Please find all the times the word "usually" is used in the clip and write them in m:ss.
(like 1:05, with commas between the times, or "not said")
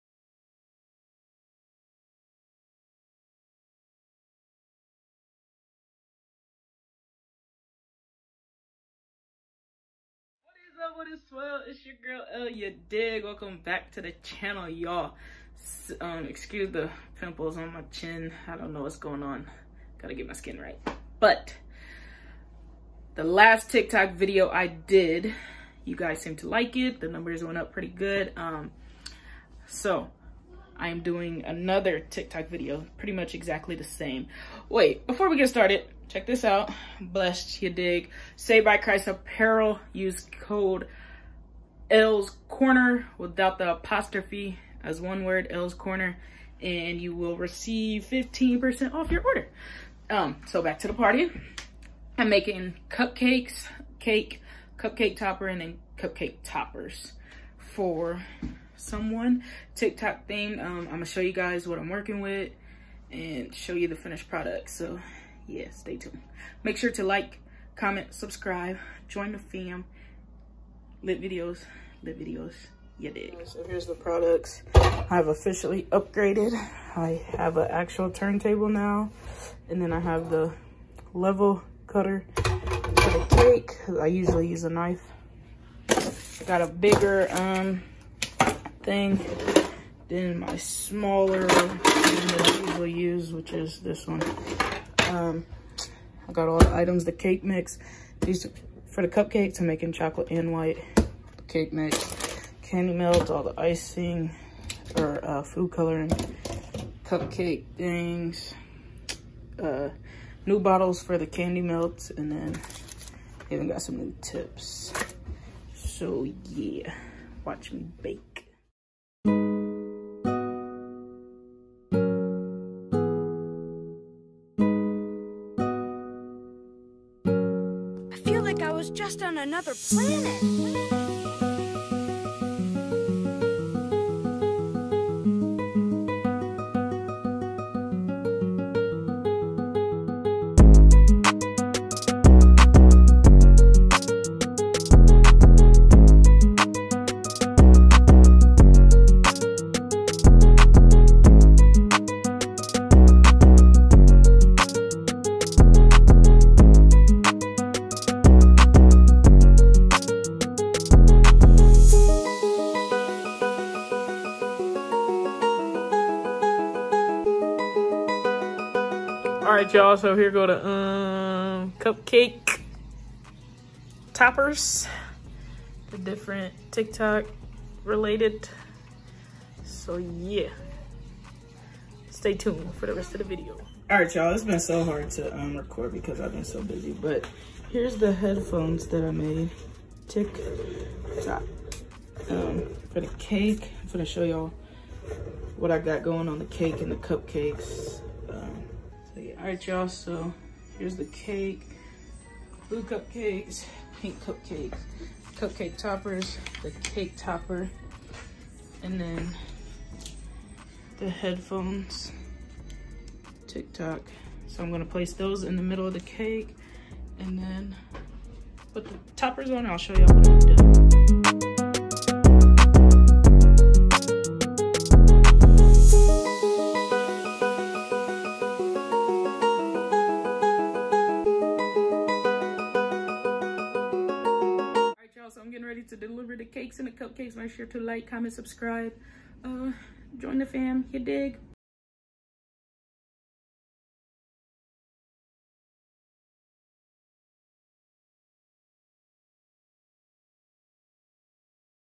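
1:24, 1:32.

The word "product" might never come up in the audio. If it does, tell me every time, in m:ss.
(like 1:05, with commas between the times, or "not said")
1:04, 1:13.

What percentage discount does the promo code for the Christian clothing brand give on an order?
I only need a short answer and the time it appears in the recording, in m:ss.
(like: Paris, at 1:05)
15%, at 0:48.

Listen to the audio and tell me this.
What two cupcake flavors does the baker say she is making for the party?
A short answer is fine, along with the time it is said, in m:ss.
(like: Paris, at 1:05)
chocolate and white, at 1:39.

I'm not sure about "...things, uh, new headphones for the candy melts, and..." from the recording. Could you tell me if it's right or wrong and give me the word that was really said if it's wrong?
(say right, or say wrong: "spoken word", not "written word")
wrong: "bottles", not "headphones".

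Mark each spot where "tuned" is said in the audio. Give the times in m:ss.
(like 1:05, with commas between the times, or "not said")
1:05, 3:02.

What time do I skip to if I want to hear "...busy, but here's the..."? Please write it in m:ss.
3:06.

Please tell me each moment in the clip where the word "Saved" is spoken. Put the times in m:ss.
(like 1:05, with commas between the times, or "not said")
0:38.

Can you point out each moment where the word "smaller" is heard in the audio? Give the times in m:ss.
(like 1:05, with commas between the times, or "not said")
1:30.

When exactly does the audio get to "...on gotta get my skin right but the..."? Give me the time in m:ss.
0:19.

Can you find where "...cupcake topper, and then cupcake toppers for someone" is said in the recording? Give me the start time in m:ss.
0:54.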